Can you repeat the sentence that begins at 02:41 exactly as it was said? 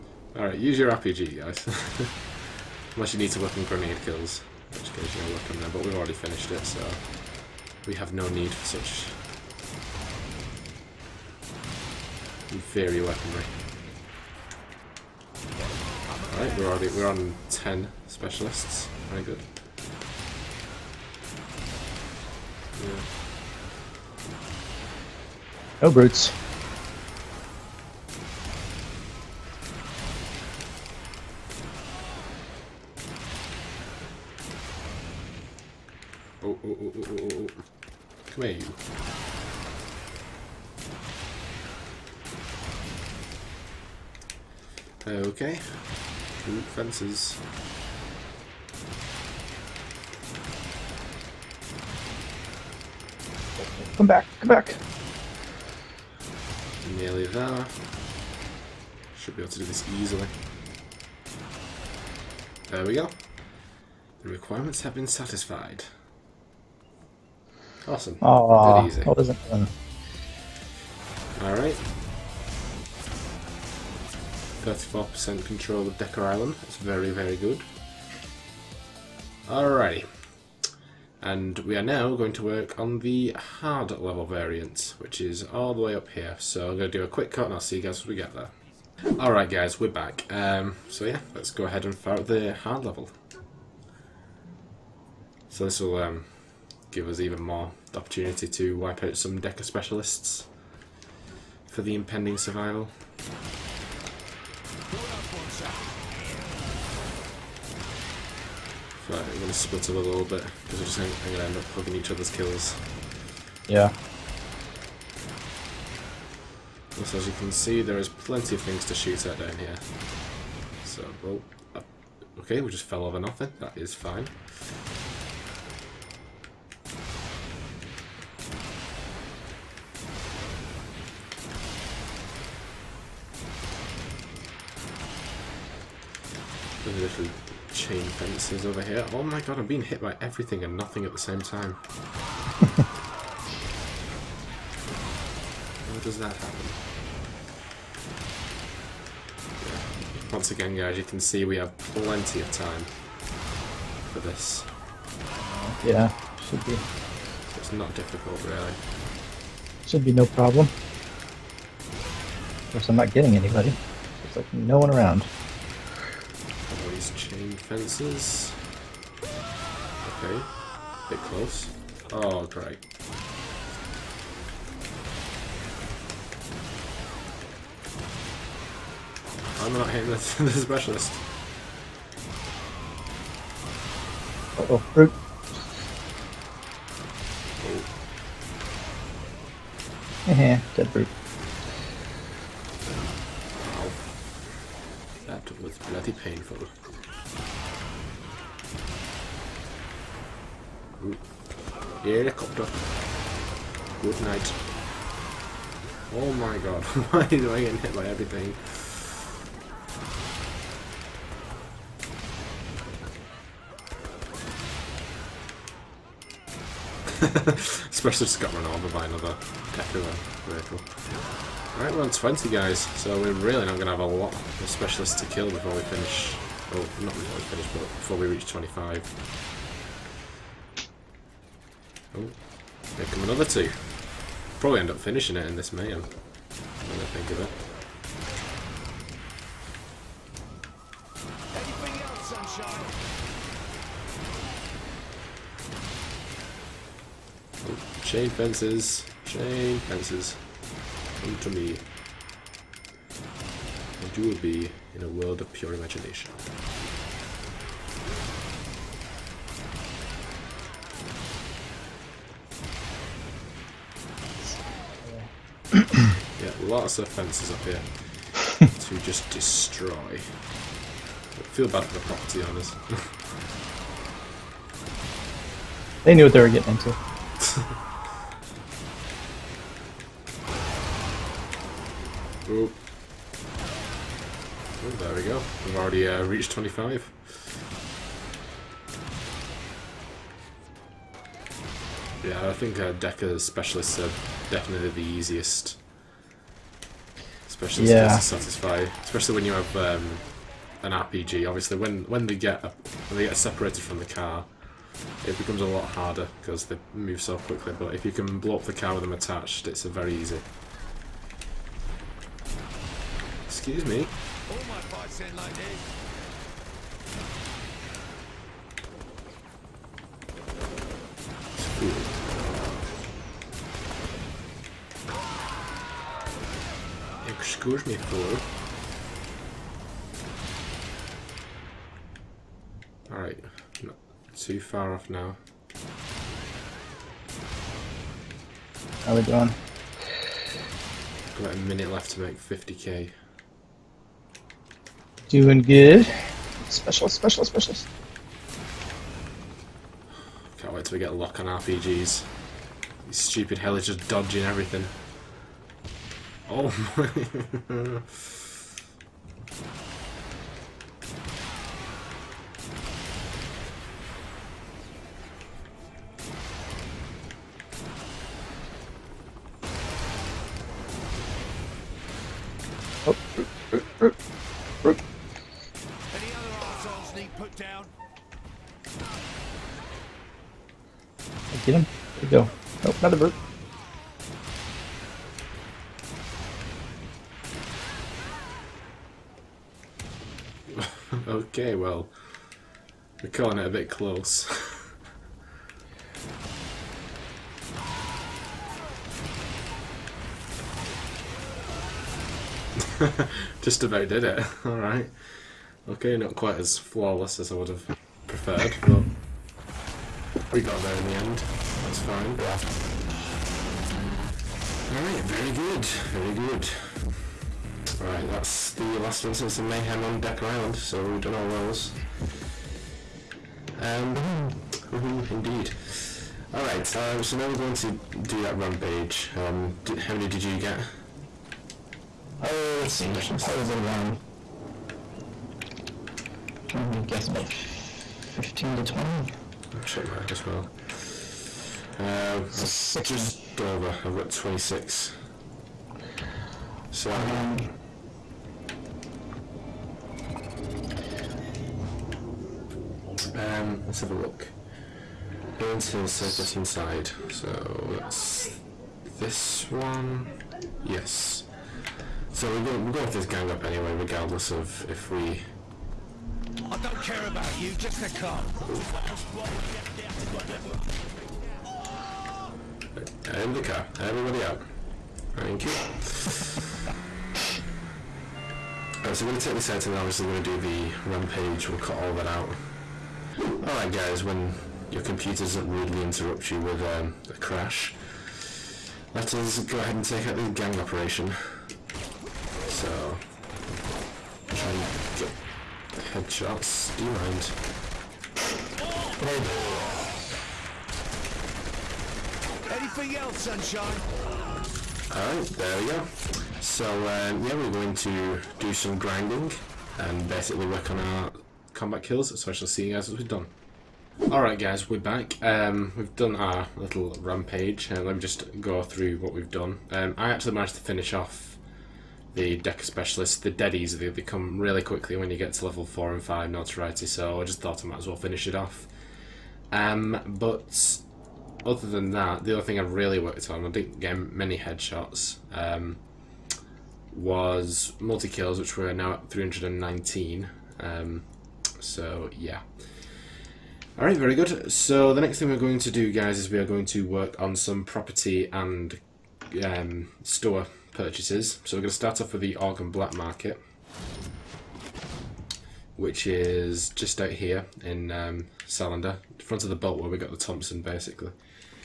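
Of course, I'm not getting anybody.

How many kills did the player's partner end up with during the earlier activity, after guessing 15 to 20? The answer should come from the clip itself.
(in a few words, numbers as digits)
26.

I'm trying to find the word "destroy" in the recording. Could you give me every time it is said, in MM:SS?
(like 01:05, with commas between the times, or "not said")
04:29.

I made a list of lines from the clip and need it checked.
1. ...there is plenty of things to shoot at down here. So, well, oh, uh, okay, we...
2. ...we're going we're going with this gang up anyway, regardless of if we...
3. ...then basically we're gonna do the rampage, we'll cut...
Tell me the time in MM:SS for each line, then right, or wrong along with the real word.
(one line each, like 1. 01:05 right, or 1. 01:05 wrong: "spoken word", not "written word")
1. 01:57 right
2. 07:42 right
3. 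07:59 wrong: "obviously", not "basically".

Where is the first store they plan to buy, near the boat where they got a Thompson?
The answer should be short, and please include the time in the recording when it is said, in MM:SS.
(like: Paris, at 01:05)
Salander, at 09:18.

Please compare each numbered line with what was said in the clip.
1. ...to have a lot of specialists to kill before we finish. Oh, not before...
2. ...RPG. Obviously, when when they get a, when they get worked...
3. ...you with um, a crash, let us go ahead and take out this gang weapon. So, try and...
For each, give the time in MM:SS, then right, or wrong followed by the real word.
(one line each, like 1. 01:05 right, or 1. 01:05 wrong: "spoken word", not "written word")
1. 03:43 right
2. 05:00 wrong: "separated", not "worked"
3. 08:06 wrong: "operation", not "weapon".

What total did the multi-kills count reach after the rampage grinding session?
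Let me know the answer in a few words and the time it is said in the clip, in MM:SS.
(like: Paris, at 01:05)
319, at 08:59.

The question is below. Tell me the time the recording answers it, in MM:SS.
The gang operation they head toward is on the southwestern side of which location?
07:35.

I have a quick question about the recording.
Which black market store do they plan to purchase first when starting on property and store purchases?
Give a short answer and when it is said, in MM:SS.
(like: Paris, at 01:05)
Argon Black Market, at 09:12.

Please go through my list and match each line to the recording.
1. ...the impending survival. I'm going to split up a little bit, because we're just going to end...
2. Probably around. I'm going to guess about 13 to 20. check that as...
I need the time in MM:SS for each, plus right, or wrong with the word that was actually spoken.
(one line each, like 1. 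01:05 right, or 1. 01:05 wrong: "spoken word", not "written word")
1. 01:41 right
2. 07:13 wrong: "15", not "13".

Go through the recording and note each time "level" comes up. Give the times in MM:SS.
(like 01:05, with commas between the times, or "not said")
01:23, 01:32, 08:45.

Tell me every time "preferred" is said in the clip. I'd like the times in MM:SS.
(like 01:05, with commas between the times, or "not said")
06:48.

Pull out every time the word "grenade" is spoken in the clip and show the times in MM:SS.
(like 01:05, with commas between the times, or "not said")
00:03, 08:19.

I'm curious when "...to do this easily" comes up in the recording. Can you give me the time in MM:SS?
00:59.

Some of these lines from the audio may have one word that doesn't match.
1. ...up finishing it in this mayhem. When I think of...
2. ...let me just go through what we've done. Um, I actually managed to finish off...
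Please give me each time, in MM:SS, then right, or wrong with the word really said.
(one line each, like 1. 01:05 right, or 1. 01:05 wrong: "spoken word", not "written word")
1. 03:54 right
2. 08:38 right.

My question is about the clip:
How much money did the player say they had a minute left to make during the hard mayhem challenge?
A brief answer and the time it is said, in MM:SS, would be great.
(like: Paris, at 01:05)
50k, at 05:42.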